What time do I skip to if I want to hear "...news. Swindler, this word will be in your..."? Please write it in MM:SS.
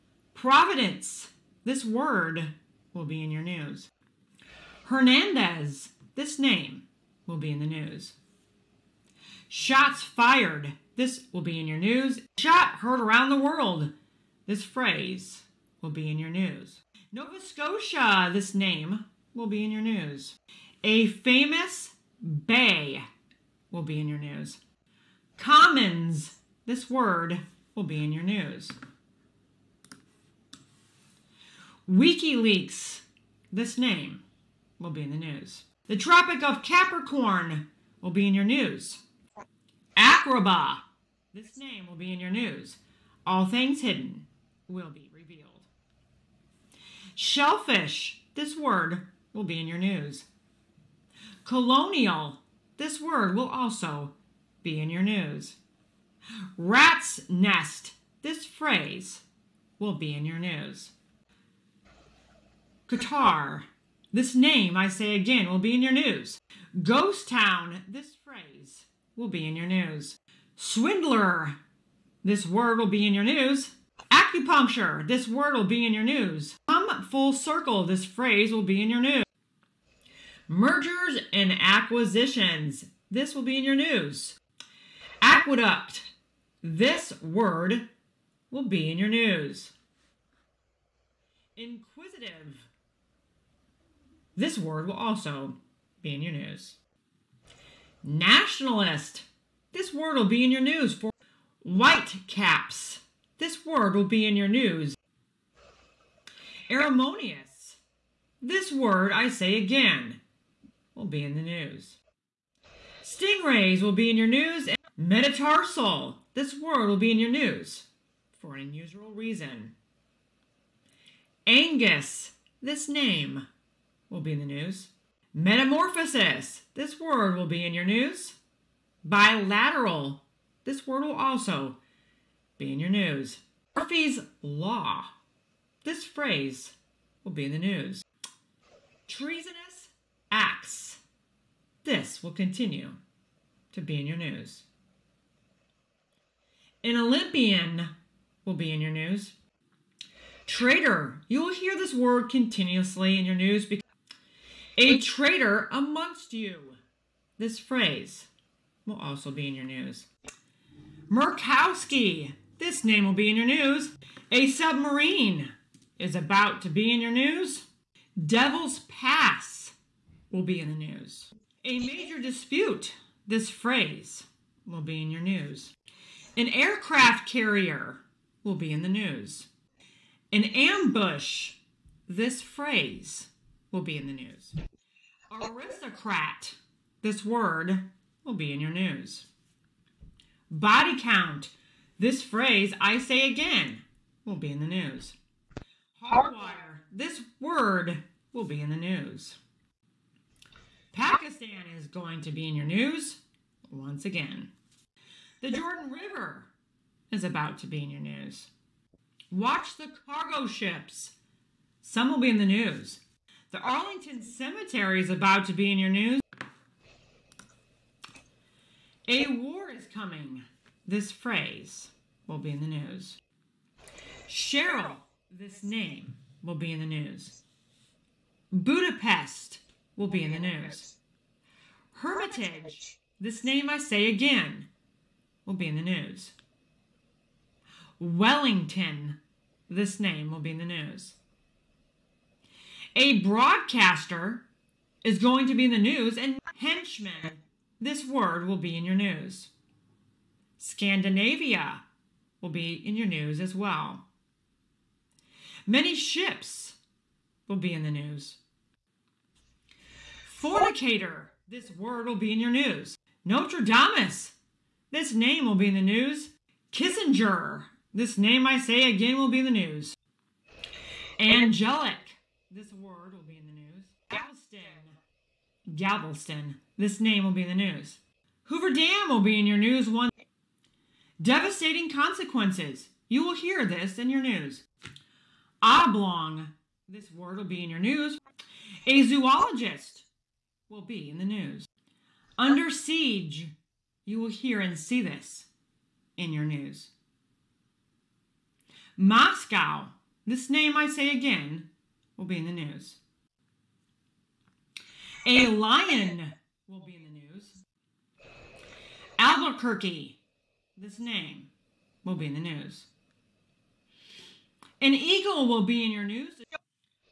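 01:09.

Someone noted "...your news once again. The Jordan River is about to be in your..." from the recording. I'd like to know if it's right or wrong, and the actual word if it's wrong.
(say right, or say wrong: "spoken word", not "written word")
right.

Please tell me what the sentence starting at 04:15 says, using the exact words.
Many ships will be in the news.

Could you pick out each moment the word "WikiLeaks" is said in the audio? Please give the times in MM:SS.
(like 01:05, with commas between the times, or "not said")
00:31.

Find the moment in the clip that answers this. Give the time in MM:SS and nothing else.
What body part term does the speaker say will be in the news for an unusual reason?
01:54.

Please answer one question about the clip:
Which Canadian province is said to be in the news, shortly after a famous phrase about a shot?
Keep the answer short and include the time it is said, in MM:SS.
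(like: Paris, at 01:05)
Nova Scotia, at 00:17.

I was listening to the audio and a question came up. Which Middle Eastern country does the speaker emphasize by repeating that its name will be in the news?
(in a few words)
Qatar.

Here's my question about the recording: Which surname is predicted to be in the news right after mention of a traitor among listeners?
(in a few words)
Murkowski.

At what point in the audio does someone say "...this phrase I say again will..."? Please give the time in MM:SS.
03:11.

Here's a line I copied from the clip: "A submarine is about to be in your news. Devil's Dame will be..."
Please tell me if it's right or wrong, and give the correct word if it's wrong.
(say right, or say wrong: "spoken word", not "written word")
wrong: "Pass", not "Dame".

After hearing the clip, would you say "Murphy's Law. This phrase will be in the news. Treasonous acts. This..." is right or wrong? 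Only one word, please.
right.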